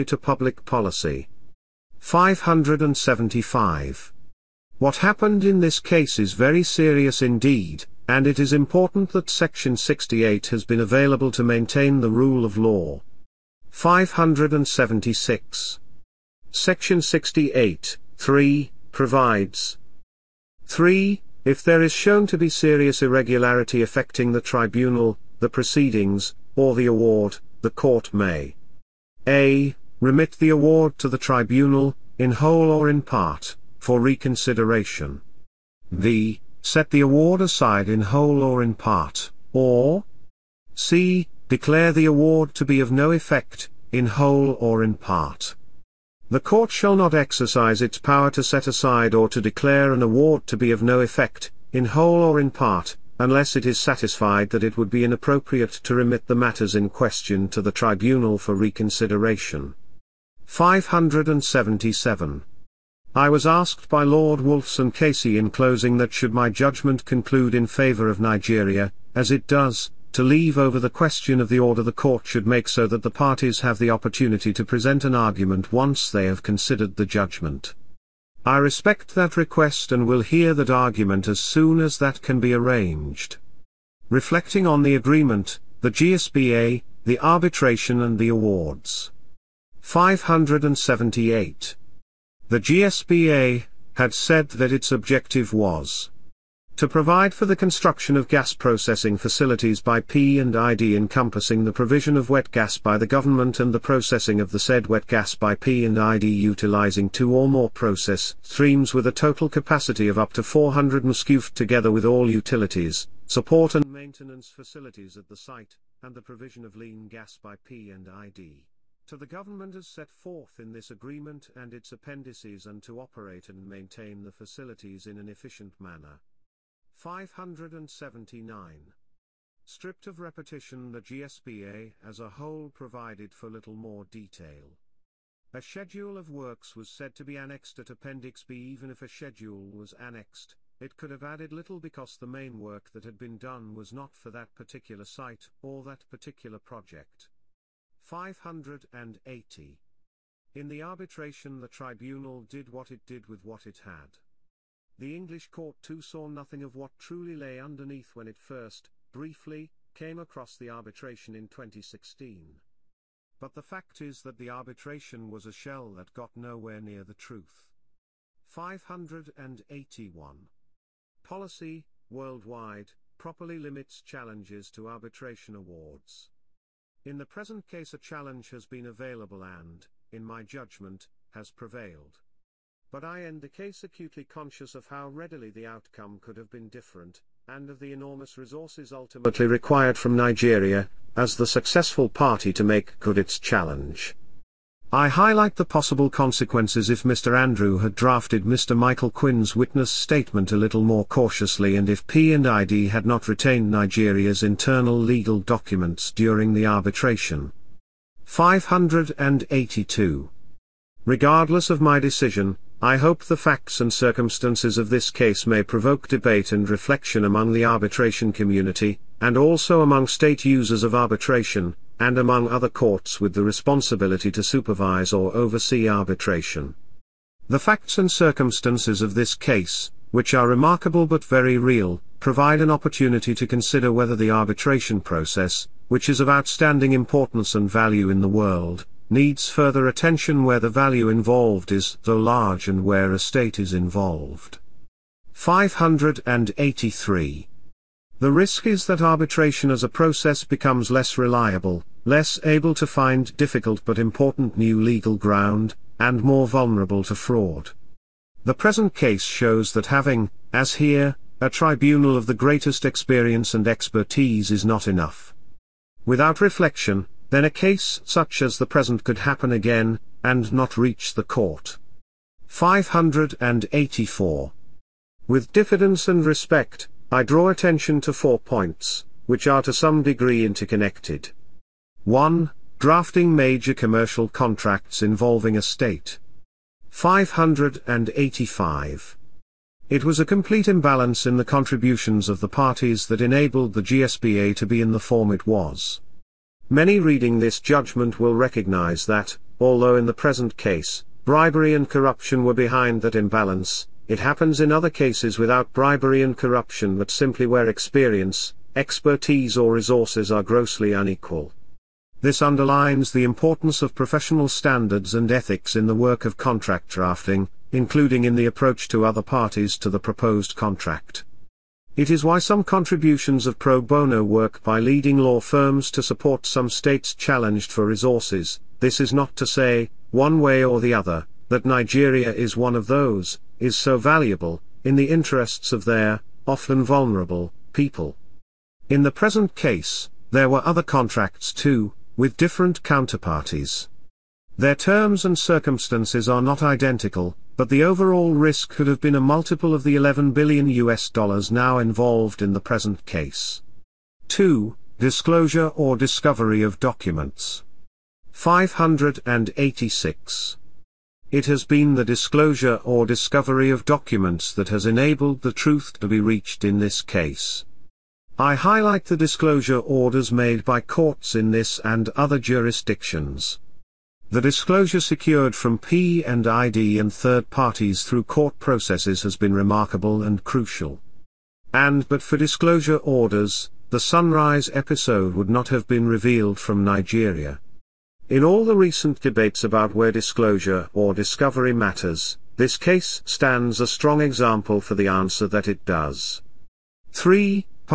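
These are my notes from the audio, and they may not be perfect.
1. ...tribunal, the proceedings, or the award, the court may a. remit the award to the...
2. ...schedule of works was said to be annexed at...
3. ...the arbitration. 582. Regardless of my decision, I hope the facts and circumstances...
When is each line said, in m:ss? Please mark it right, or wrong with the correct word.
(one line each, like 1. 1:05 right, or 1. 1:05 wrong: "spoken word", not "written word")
1. 0:24 right
2. 2:15 right
3. 3:26 right.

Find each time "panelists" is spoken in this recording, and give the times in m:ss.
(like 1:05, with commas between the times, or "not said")
not said.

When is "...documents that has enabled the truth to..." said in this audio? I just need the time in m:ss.
6:03.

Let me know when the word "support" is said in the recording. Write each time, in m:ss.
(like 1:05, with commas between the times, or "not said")
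1:53, 5:26.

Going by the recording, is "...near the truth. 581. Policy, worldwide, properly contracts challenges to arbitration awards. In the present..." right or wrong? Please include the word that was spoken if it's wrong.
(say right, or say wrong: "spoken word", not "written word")
wrong: "limits", not "contracts".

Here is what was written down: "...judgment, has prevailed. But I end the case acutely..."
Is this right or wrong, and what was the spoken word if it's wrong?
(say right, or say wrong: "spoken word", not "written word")
right.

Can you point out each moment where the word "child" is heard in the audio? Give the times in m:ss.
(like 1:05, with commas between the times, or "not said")
not said.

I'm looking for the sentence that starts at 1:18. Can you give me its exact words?
I respect that request and will hear that argument as soon as that can be arranged.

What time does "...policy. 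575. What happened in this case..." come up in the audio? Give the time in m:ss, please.
0:00.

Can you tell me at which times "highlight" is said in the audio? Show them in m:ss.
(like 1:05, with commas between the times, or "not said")
3:15, 6:08.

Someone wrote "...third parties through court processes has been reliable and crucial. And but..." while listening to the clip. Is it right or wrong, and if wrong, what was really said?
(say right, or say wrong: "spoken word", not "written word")
wrong: "remarkable", not "reliable".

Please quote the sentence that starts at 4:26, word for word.
Without reflection, then a case such as the present could happen again, and not reach the court.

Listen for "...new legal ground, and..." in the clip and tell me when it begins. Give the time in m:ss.
4:14.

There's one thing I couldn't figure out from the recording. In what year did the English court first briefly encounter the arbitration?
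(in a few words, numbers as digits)
2016.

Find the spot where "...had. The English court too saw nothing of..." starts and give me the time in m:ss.
2:33.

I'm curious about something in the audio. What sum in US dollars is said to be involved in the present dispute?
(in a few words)
11 billion US dollars.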